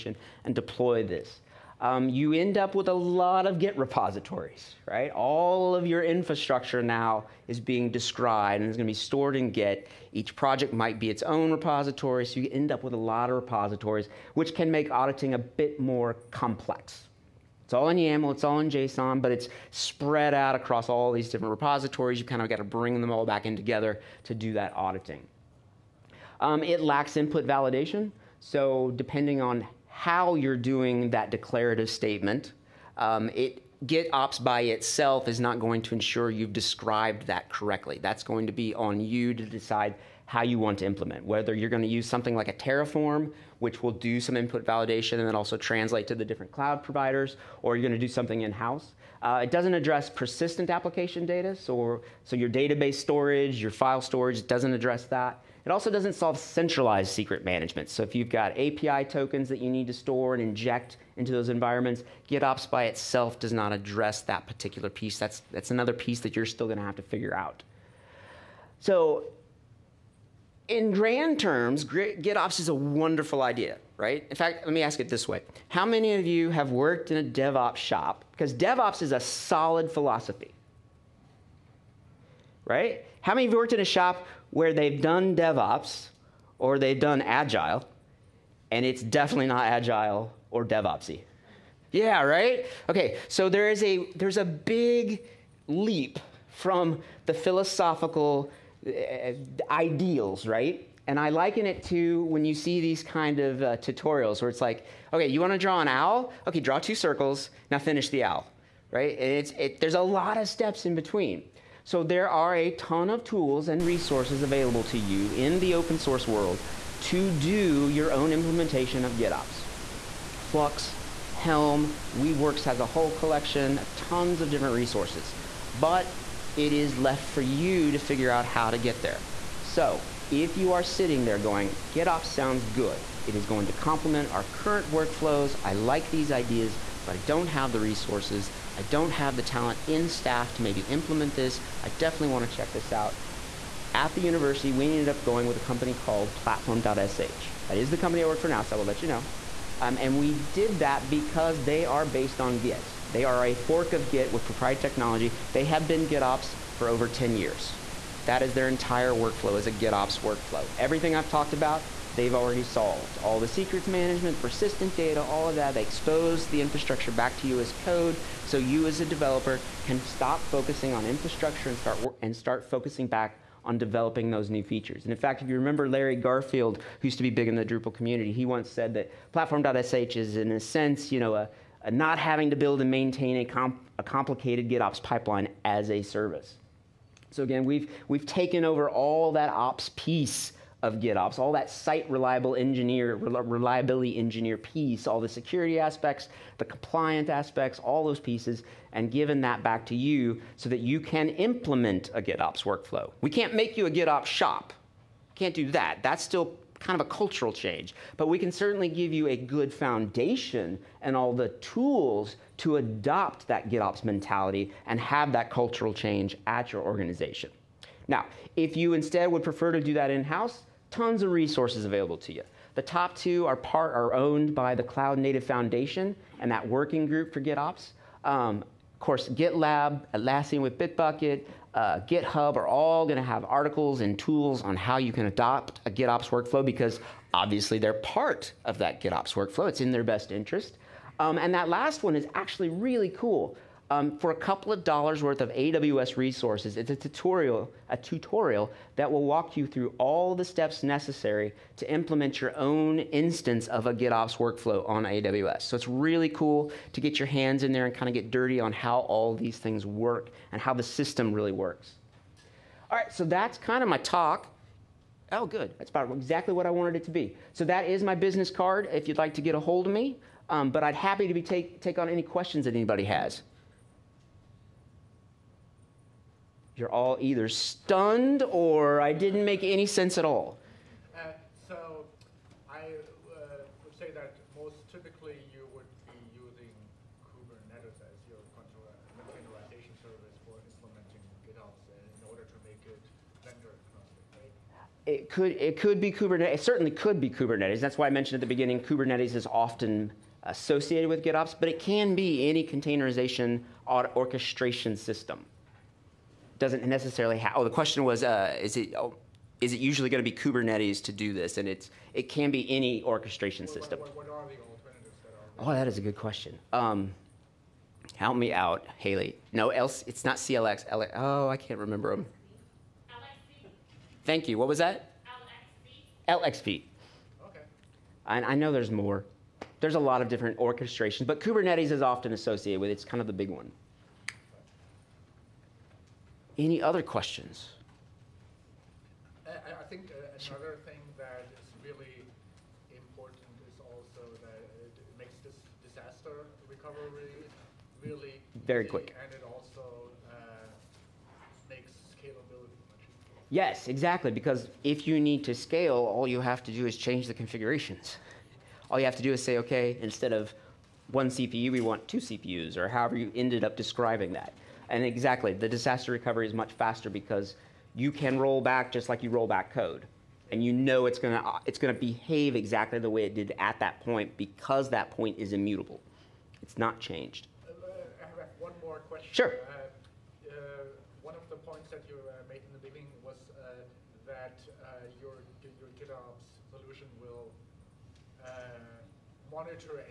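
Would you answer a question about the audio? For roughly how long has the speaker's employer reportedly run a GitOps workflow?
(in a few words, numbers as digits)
Over 10 years.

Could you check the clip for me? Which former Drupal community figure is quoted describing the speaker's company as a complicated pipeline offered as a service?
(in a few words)
Larry Garfield.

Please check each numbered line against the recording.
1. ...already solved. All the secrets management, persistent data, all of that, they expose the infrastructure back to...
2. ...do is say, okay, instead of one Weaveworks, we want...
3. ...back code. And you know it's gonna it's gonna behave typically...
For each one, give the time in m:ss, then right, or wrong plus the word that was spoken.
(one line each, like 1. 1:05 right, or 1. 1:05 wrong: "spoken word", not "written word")
1. 2:42 right
2. 5:59 wrong: "CPU", not "Weaveworks"
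3. 6:09 wrong: "exactly", not "typically".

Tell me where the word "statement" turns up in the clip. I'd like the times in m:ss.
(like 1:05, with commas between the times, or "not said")
0:31.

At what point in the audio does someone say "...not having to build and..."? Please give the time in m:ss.
3:01.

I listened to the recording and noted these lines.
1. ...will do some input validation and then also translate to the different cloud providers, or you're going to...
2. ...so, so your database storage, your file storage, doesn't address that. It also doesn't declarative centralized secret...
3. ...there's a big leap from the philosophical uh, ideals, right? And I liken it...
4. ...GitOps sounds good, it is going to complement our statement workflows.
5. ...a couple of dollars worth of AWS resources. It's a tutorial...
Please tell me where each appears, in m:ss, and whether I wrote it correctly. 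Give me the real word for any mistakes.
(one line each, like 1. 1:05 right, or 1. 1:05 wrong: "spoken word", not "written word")
1. 0:43 right
2. 0:51 wrong: "solve", not "declarative"
3. 1:34 right
4. 2:11 wrong: "current", not "statement"
5. 4:04 right.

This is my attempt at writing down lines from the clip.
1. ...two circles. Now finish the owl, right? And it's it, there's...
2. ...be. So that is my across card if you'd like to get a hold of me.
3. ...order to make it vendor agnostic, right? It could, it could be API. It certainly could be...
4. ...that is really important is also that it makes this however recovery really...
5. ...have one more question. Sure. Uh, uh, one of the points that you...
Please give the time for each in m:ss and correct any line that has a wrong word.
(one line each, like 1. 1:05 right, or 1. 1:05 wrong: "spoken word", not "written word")
1. 1:46 right
2. 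4:27 wrong: "business", not "across"
3. 4:52 wrong: "Kubernetes", not "API"
4. 5:41 wrong: "disaster", not "however"
5. 6:18 right.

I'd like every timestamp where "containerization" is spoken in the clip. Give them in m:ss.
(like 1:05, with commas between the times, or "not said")
4:48, 5:02.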